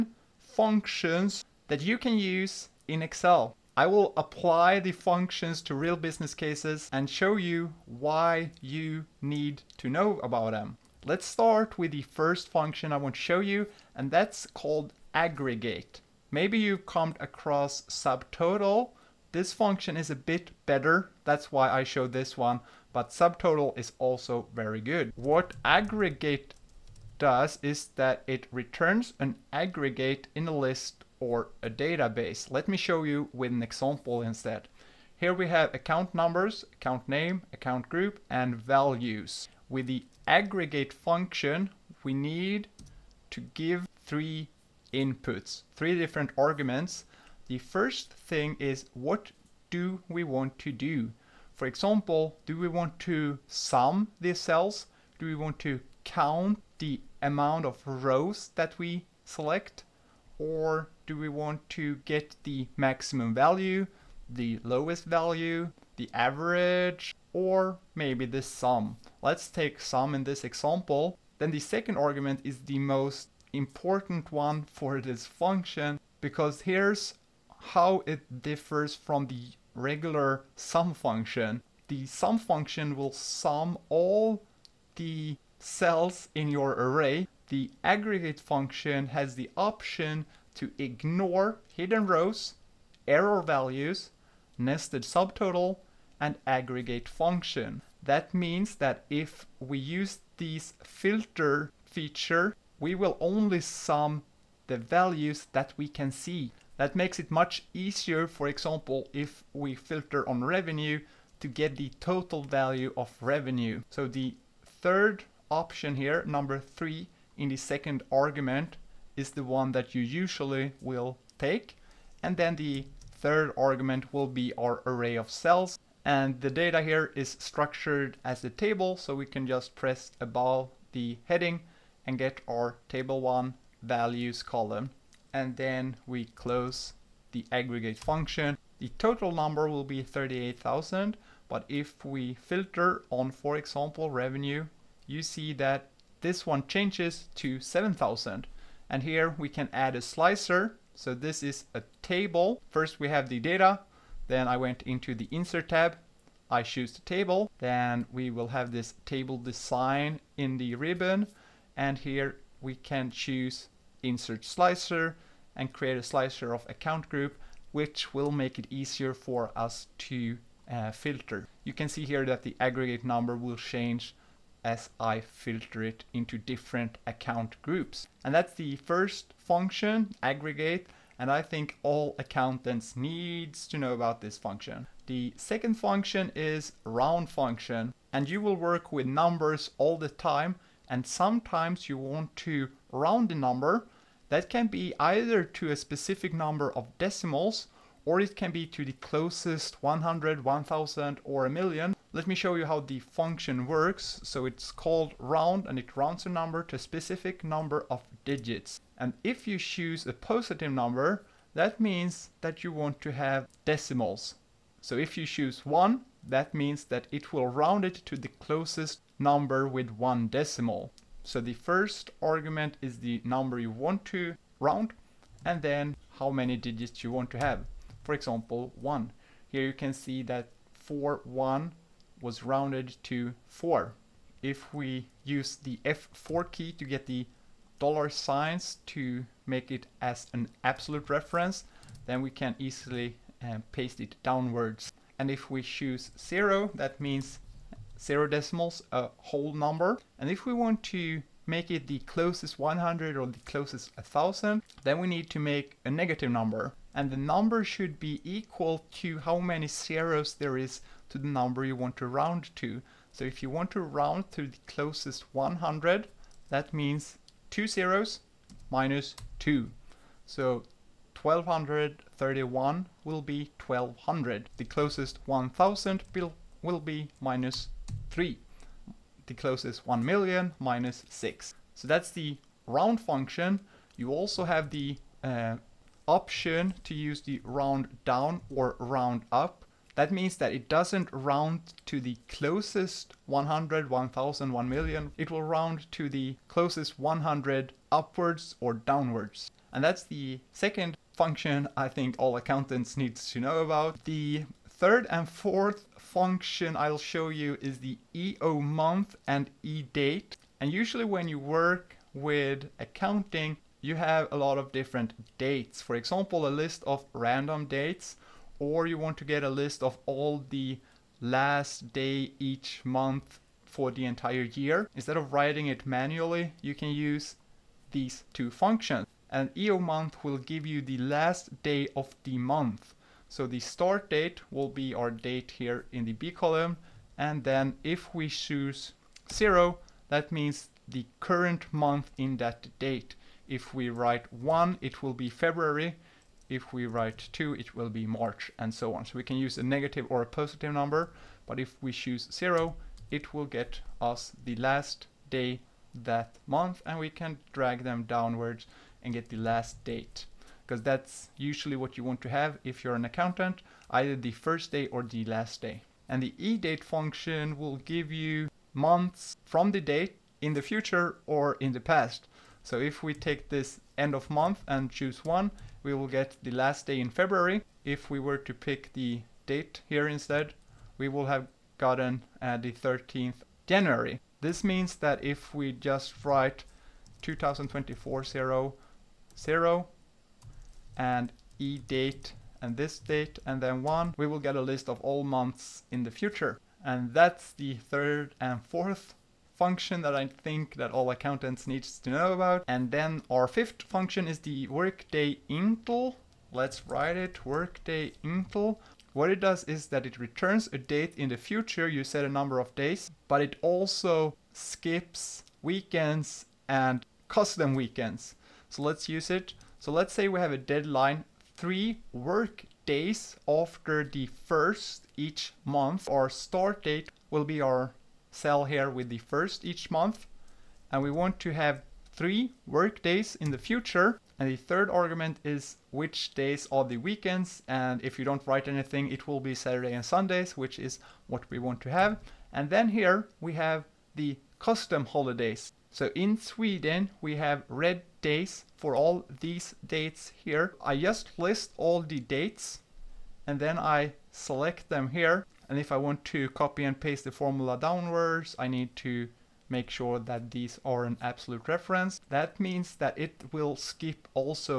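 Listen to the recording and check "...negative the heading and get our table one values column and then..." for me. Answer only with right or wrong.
wrong.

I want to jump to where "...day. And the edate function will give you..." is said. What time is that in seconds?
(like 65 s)
365 s.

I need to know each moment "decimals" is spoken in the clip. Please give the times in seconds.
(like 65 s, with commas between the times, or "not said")
196 s, 213 s, 220 s, 248 s.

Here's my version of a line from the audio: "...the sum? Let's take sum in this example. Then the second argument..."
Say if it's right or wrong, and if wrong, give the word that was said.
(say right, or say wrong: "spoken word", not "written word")
right.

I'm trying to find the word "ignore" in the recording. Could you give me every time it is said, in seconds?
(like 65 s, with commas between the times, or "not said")
90 s.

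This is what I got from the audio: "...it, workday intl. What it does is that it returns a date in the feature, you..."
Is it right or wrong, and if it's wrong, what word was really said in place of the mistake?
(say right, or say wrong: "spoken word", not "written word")
wrong: "future", not "feature".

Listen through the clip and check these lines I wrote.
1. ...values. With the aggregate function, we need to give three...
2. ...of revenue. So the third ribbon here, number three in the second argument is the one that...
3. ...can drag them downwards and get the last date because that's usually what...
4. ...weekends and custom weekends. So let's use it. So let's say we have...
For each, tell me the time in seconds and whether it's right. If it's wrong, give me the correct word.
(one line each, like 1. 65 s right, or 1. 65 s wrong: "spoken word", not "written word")
1. 38 s right
2. 112 s wrong: "option", not "ribbon"
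3. 357 s right
4. 415 s right.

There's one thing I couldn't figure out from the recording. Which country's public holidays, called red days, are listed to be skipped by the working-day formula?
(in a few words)
Sweden.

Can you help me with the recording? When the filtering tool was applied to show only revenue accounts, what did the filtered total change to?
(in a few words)
7,000.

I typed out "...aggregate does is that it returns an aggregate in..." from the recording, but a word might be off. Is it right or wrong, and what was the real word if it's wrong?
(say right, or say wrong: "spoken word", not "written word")
right.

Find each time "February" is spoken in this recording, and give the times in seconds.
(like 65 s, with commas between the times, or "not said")
345 s, 377 s.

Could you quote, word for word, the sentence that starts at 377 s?
If we were to pick the date here instead, we will have gotten uh, the 13th January.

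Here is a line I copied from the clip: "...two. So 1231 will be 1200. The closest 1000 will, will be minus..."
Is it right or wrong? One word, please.
right.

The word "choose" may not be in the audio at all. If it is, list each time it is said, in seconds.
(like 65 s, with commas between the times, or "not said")
156 s, 163 s, 209 s, 215 s, 245 s, 338 s, 351 s, 374 s.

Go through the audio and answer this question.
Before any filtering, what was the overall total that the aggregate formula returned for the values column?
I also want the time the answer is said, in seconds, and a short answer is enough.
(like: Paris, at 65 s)
38,000, at 140 s.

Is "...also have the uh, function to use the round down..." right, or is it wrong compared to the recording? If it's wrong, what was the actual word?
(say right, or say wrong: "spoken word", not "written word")
wrong: "option", not "function".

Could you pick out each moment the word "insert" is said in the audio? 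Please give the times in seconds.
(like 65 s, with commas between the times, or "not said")
155 s, 164 s.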